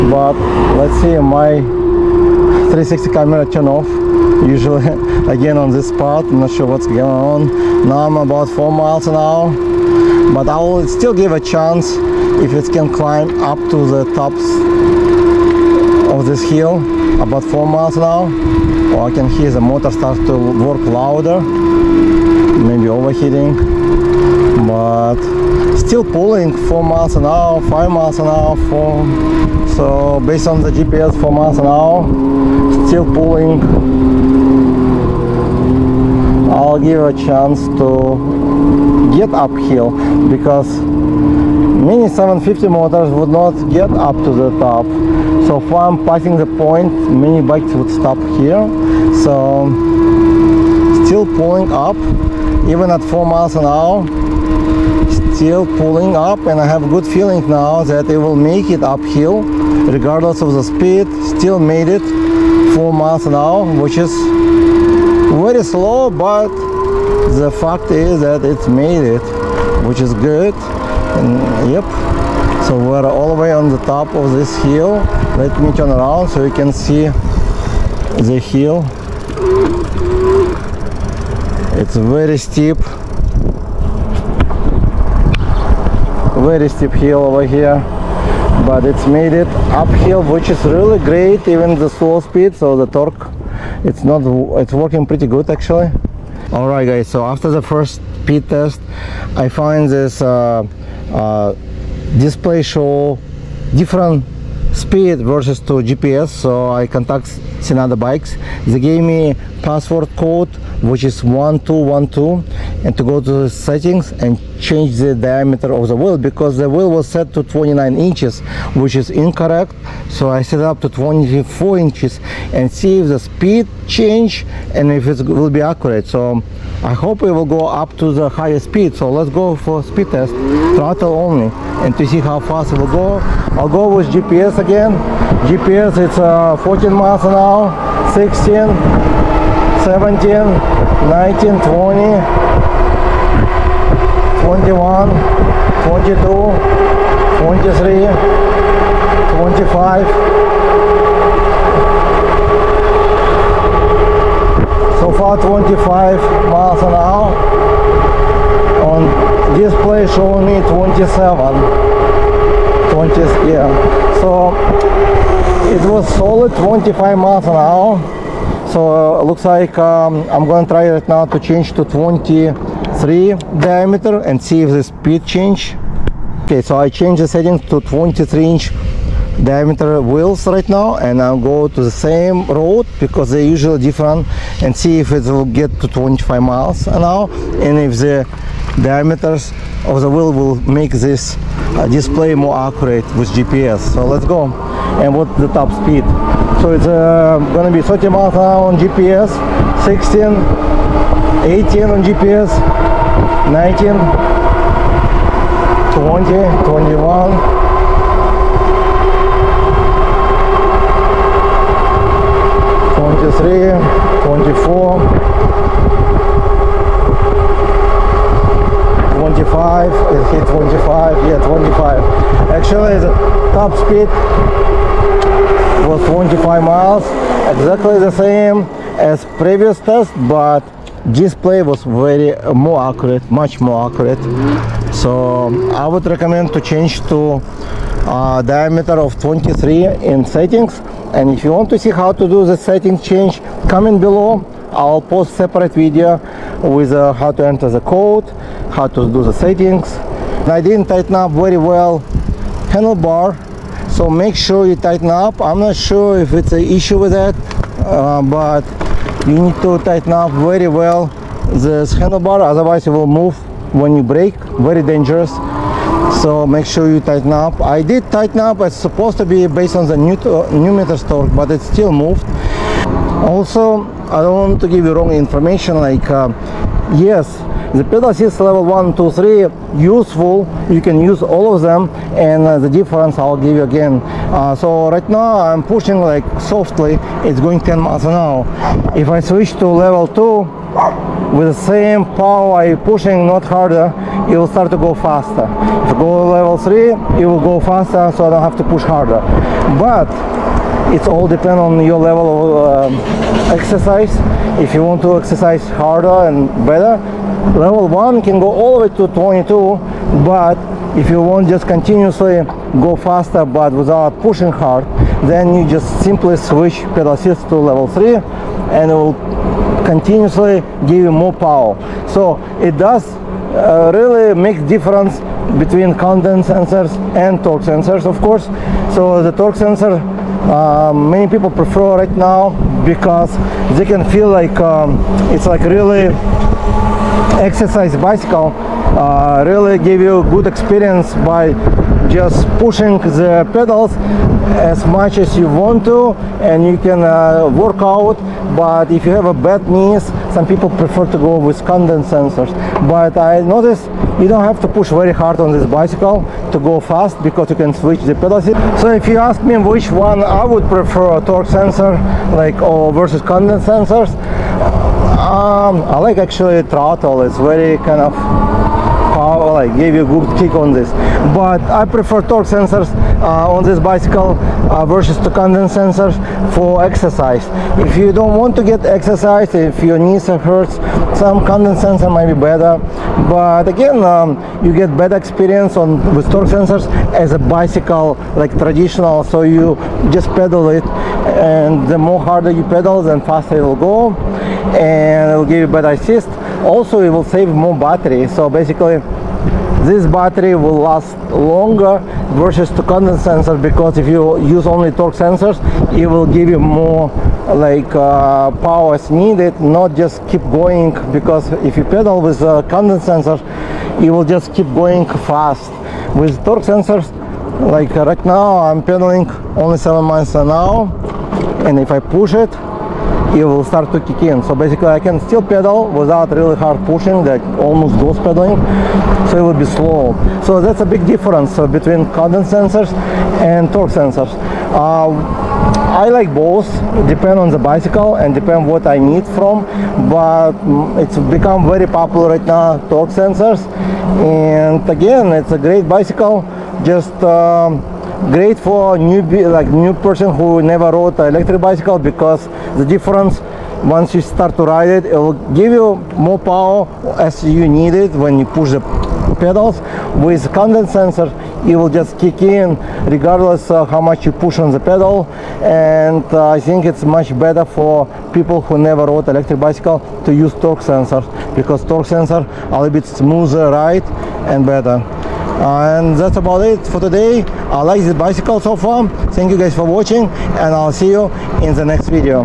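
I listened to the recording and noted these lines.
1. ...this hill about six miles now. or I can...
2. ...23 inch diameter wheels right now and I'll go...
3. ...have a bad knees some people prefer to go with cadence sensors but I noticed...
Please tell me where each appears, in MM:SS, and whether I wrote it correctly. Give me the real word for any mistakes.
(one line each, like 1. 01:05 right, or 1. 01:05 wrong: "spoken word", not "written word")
1. 00:16 wrong: "four", not "six"
2. 02:57 right
3. 05:49 right.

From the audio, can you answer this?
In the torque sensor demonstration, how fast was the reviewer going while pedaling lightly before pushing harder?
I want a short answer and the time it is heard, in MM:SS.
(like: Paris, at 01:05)
7 miles an hour, at 06:59.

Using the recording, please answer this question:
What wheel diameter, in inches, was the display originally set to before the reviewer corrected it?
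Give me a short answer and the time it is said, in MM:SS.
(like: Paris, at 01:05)
29 inches, at 01:57.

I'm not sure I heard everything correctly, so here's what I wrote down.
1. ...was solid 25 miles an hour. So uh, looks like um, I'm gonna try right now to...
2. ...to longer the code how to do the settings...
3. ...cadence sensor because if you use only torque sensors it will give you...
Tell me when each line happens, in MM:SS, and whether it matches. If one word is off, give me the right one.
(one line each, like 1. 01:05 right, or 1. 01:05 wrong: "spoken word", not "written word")
1. 02:45 right
2. 04:07 wrong: "enter", not "longer"
3. 06:42 right.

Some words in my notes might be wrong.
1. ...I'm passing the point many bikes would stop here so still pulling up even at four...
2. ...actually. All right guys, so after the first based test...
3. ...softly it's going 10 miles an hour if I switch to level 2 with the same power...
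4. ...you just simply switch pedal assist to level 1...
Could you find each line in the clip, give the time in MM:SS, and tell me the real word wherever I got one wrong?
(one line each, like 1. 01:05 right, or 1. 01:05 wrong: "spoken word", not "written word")
1. 00:45 right
2. 01:35 wrong: "speed", not "based"
3. 04:46 right
4. 05:15 wrong: "3", not "1".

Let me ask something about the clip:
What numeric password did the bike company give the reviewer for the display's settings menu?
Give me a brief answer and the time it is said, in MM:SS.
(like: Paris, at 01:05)
1212, at 01:51.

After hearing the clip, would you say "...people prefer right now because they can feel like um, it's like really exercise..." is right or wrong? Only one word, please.
right.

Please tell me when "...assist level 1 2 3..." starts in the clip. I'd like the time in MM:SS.
04:38.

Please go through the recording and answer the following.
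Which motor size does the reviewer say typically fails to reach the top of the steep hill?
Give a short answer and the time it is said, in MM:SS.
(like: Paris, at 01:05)
750, at 00:42.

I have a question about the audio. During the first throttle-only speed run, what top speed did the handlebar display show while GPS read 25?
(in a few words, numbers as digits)
27.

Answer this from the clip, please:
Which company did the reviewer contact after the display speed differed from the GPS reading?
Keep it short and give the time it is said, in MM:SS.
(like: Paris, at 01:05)
Senada bikes, at 01:47.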